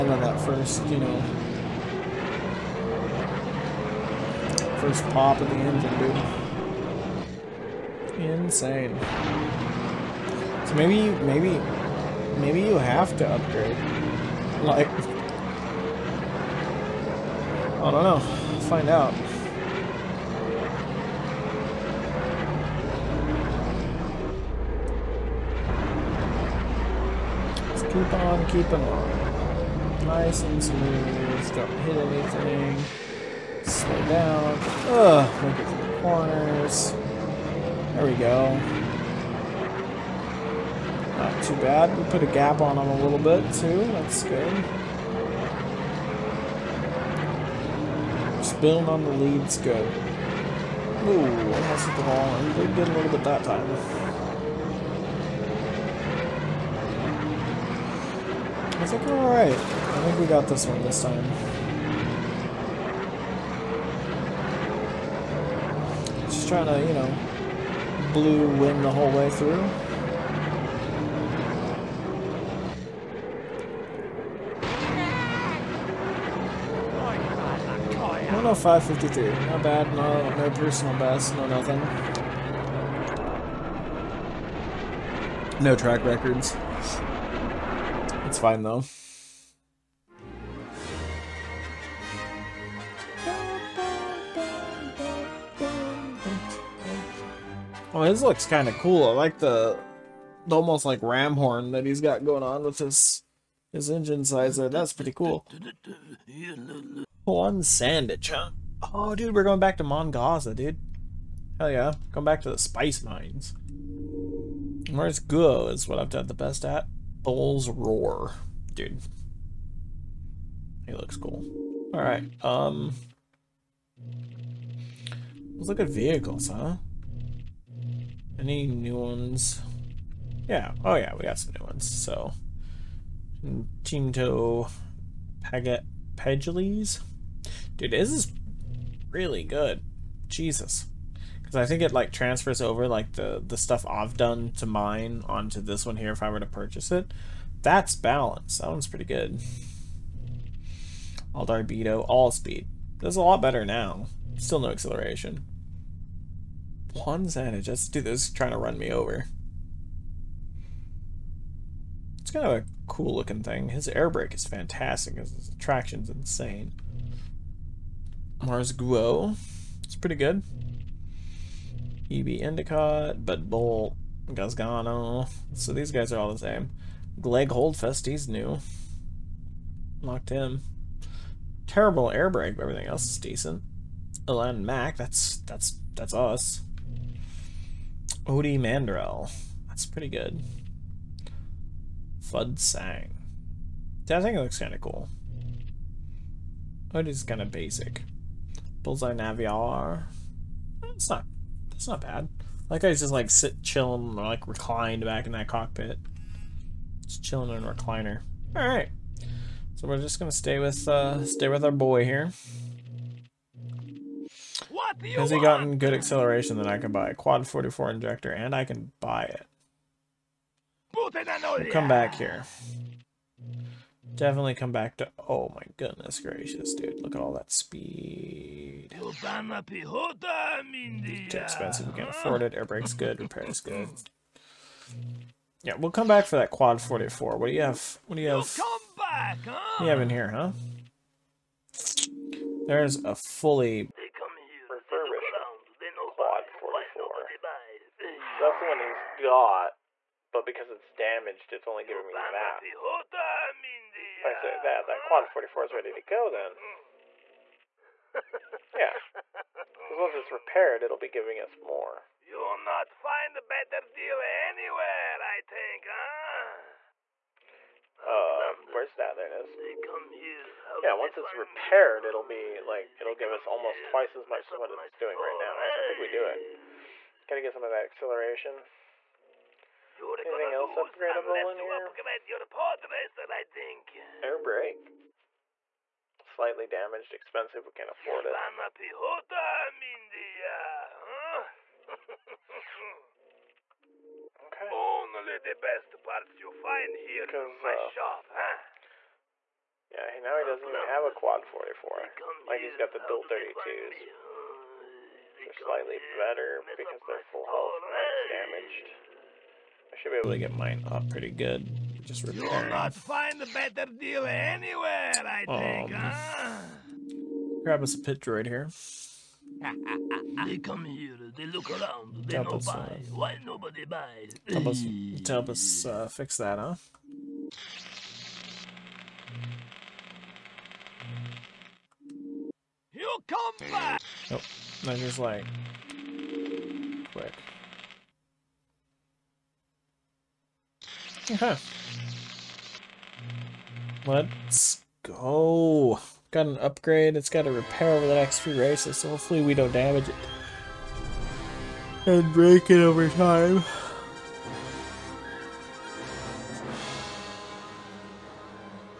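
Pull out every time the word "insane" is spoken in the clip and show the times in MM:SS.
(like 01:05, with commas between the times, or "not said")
00:08, 02:46.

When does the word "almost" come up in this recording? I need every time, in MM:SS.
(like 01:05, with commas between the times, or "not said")
00:51, 01:40, 04:33.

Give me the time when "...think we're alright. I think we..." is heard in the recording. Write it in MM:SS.
00:58.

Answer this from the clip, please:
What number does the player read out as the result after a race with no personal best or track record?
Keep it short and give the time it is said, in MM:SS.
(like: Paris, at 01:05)
553, at 01:18.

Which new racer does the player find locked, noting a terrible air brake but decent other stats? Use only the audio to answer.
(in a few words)
Clegg Holdfast.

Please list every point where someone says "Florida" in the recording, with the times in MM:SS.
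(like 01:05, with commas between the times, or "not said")
not said.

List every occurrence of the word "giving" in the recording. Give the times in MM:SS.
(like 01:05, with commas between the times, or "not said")
04:11, 04:21.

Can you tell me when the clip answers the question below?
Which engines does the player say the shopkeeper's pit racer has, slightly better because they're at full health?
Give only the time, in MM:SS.
05:02.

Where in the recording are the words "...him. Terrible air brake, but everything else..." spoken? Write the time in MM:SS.
03:00.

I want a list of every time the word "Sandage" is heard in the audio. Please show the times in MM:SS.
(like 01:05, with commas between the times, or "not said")
01:47, 02:37.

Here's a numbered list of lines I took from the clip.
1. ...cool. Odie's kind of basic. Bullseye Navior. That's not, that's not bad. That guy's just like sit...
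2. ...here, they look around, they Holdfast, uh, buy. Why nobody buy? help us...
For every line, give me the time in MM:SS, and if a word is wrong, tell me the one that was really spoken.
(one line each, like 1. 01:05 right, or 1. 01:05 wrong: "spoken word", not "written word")
1. 03:14 right
2. 05:20 wrong: "Tabas", not "Holdfast".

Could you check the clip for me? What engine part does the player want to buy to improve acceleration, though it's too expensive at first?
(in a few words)
Quad 44 injector.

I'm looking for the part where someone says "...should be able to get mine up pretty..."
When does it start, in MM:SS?
05:09.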